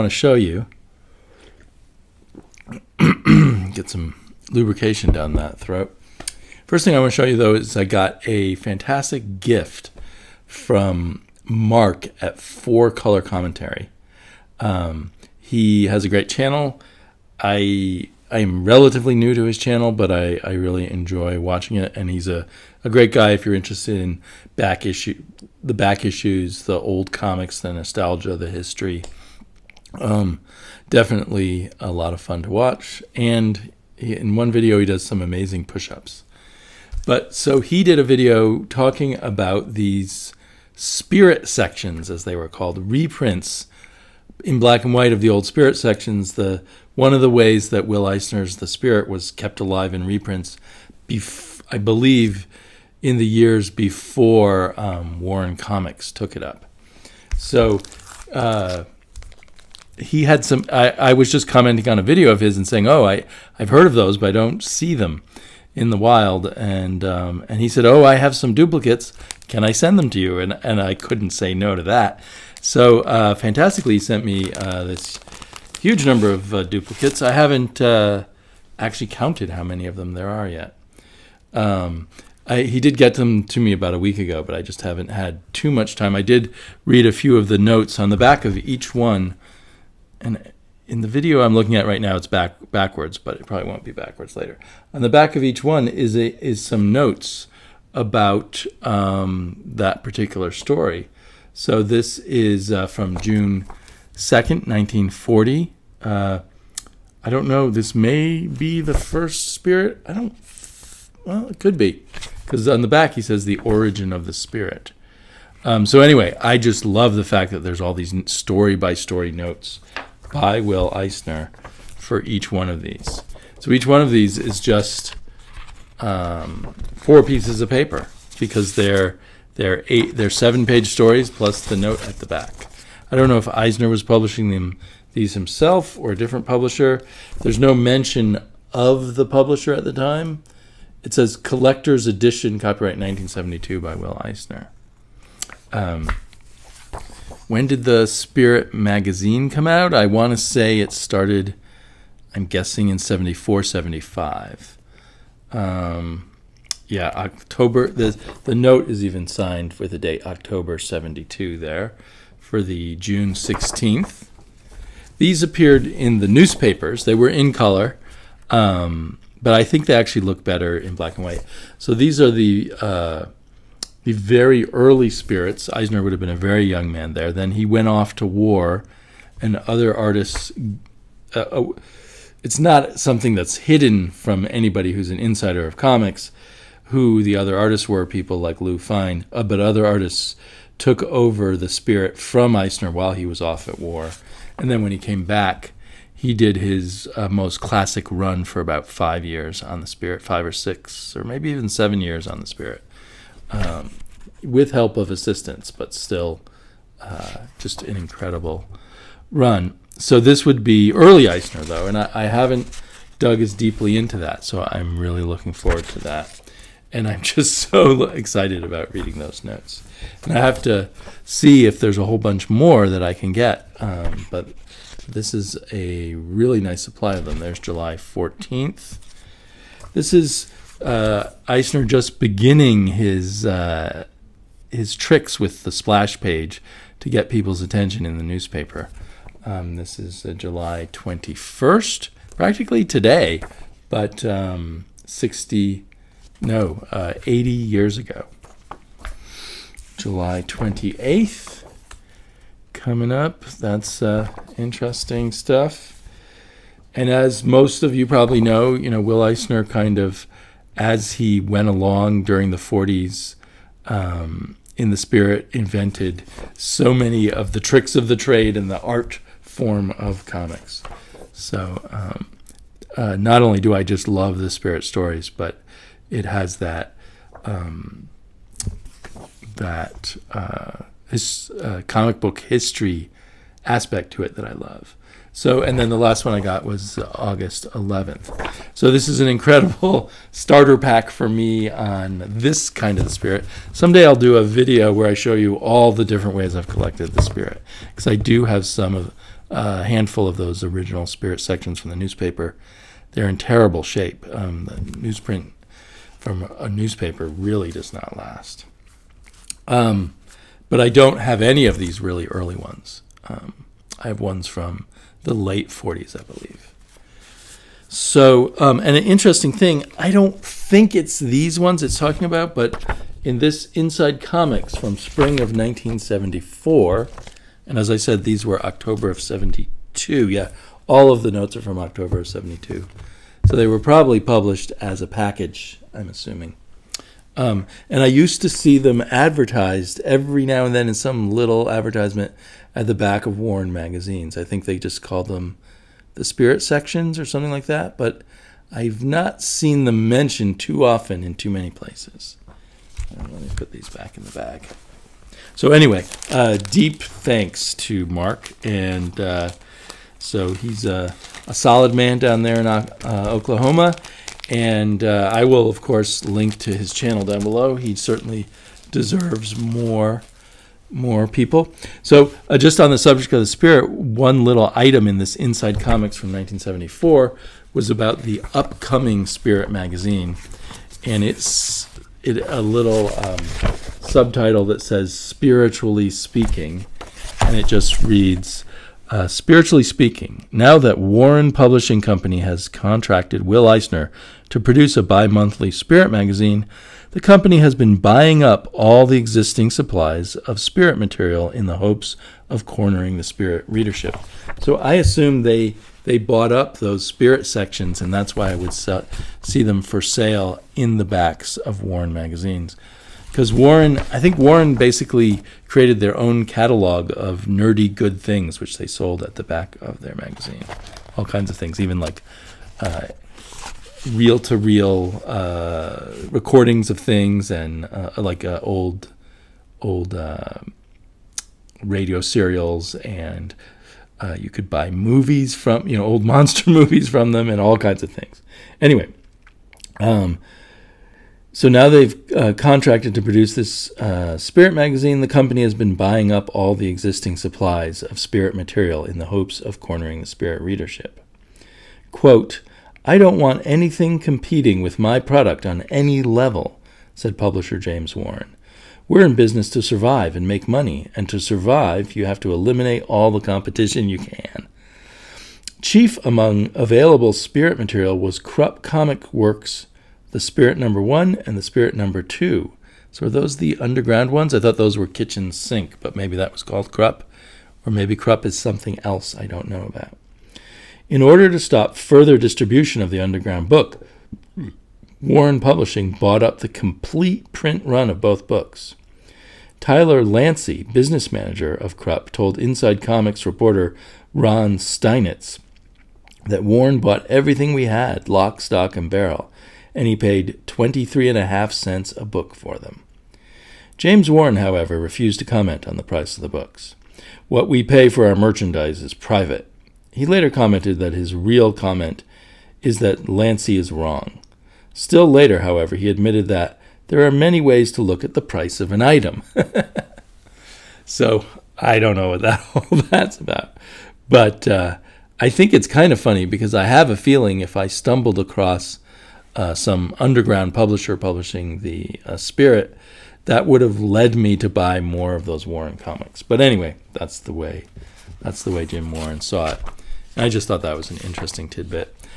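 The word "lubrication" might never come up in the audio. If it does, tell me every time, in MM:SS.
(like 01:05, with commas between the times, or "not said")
00:04.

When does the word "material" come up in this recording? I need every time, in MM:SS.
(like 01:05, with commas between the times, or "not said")
06:40, 07:28, 07:47.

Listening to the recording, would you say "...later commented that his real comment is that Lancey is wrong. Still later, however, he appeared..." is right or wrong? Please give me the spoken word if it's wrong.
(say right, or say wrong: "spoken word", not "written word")
wrong: "admitted", not "appeared".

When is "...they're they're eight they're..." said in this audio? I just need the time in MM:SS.
02:08.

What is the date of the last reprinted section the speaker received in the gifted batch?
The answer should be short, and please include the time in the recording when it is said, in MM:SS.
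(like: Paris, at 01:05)
August 11th, at 04:47.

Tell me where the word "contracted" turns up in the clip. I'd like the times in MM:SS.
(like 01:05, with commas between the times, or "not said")
06:32, 07:22.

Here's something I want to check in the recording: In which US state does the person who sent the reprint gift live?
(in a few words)
Oklahoma.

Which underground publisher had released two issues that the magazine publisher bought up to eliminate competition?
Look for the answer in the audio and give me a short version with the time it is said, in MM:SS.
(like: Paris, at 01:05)
Krupp Comic Works, at 07:48.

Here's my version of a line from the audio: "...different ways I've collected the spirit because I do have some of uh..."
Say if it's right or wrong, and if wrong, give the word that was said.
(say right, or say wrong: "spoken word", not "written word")
right.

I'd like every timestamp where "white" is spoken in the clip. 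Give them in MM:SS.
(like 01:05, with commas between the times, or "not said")
00:44, 02:51.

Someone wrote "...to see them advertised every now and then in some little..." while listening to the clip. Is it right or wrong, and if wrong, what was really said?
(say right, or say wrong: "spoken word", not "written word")
right.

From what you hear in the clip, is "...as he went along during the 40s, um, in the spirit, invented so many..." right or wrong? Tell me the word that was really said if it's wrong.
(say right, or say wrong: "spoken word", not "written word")
right.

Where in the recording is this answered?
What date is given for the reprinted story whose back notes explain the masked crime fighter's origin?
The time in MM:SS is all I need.
01:43.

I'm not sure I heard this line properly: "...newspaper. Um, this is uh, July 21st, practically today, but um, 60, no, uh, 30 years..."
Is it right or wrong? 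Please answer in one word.
wrong.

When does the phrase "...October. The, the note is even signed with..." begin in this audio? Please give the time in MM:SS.
02:37.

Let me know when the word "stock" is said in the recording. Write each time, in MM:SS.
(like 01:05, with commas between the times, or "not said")
08:18.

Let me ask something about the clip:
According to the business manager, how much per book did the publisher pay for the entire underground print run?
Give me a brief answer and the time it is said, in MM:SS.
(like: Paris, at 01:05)
23 and a half cents, at 08:20.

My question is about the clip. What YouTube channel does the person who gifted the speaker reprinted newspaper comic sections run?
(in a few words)
Four Color Commentary.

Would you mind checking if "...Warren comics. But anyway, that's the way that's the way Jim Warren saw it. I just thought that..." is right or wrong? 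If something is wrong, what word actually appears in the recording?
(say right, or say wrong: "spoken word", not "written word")
right.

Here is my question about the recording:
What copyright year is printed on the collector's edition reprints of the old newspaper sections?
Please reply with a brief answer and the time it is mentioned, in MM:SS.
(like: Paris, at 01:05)
1972, at 02:22.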